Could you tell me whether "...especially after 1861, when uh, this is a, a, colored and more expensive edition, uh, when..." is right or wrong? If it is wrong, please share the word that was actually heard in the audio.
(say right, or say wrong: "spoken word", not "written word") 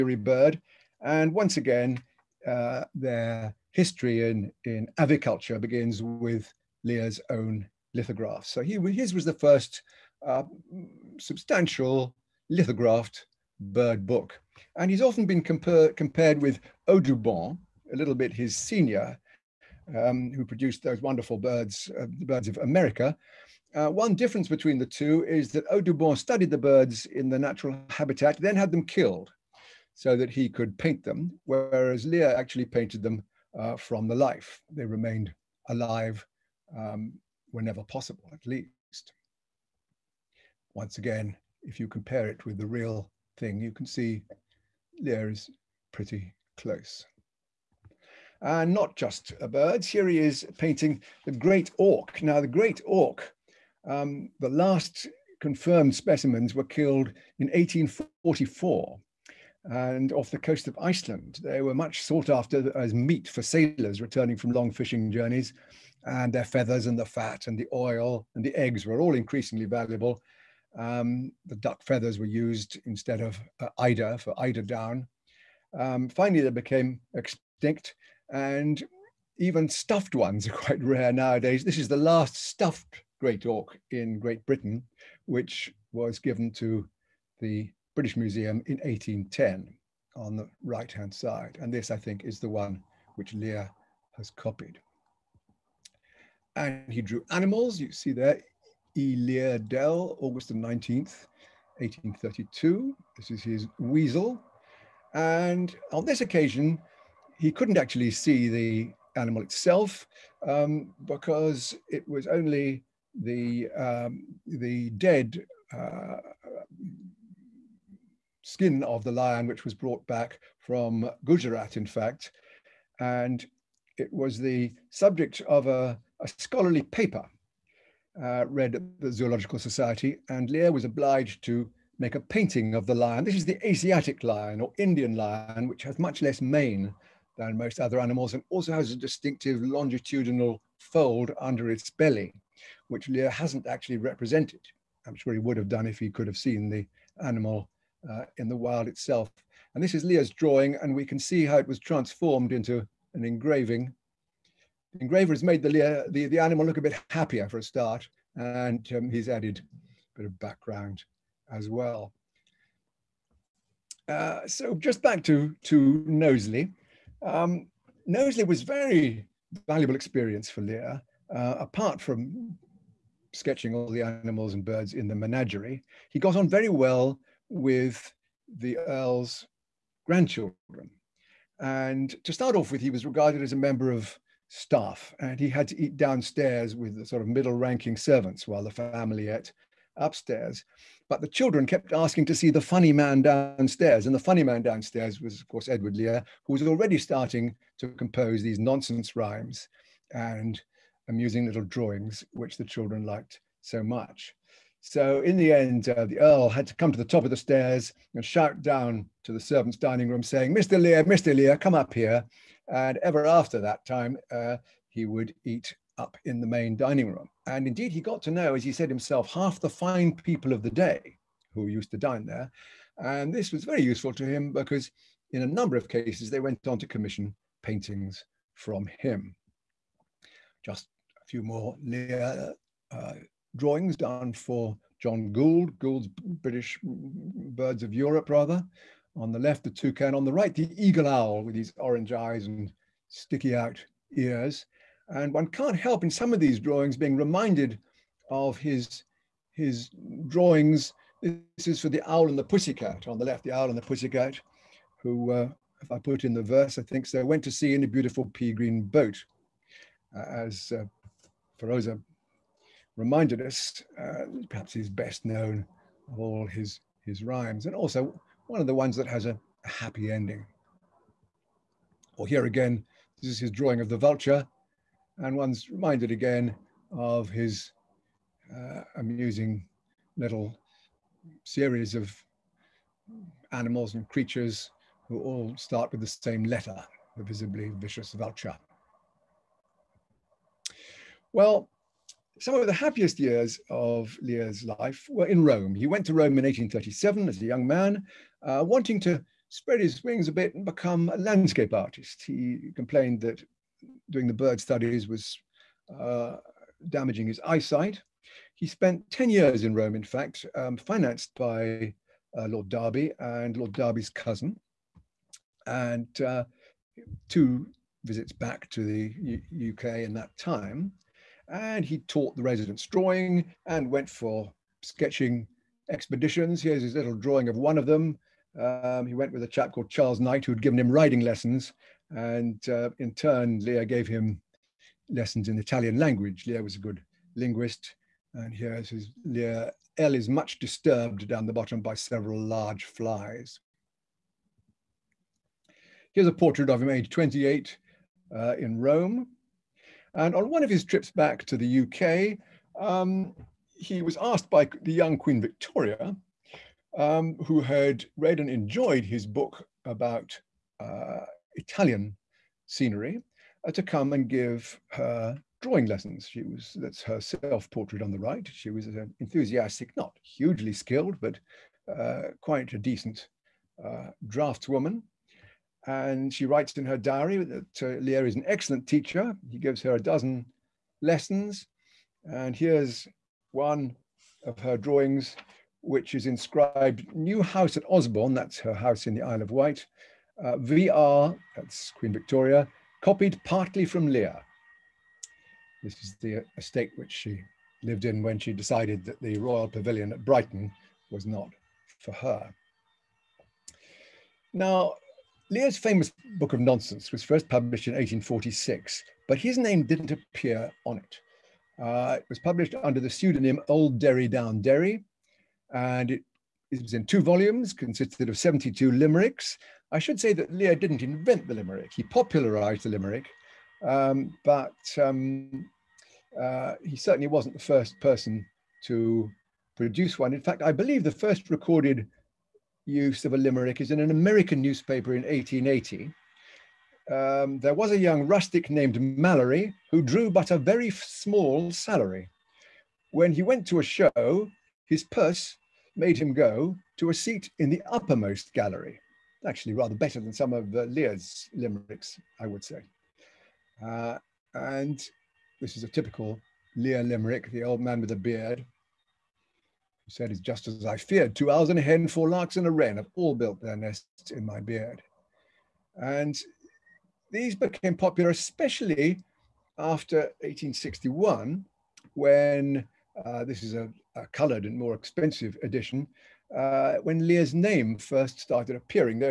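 right.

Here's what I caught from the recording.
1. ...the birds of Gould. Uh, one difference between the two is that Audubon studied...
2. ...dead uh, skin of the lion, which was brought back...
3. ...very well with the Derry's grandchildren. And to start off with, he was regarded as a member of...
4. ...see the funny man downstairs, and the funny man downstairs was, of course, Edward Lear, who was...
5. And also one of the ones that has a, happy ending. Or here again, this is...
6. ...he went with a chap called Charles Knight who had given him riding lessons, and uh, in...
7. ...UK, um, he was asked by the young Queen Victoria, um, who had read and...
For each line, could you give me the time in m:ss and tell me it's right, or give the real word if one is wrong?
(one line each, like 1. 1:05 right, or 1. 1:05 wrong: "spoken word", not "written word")
1. 0:22 wrong: "America", not "Gould"
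2. 1:54 right
3. 2:56 wrong: "Earl", not "Derry"
4. 3:12 right
5. 4:27 right
6. 5:29 right
7. 5:51 right.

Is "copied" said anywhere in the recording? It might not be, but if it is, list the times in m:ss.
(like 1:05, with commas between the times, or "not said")
1:34, 6:33.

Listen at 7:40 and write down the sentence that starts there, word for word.
He said, "Is just as I feared.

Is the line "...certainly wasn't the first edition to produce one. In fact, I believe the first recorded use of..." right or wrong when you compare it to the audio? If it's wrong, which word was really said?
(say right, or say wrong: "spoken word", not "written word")
wrong: "person", not "edition".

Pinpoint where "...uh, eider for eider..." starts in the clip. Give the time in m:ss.
1:13.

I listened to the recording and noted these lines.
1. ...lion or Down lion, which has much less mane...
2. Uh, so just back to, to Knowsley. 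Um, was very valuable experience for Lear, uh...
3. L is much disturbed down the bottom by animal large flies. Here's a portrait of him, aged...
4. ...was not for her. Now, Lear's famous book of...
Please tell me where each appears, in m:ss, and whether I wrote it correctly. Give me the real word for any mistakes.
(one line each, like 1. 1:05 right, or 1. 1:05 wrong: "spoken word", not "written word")
1. 2:14 wrong: "Indian", not "Down"
2. 2:44 right
3. 5:39 wrong: "several", not "animal"
4. 6:41 right.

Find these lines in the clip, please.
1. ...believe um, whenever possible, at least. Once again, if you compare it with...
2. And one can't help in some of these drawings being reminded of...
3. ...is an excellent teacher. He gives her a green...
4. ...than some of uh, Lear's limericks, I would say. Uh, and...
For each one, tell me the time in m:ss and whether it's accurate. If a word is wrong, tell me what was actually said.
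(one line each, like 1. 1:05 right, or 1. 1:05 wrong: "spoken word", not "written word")
1. 0:35 wrong: "alive", not "believe"
2. 4:05 right
3. 6:18 wrong: "dozen", not "green"
4. 7:30 right.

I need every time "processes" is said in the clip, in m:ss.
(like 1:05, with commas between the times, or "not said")
not said.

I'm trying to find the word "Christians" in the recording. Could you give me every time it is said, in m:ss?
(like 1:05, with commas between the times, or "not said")
not said.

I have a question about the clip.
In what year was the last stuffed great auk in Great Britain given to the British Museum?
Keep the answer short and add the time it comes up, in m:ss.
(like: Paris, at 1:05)
1810, at 1:28.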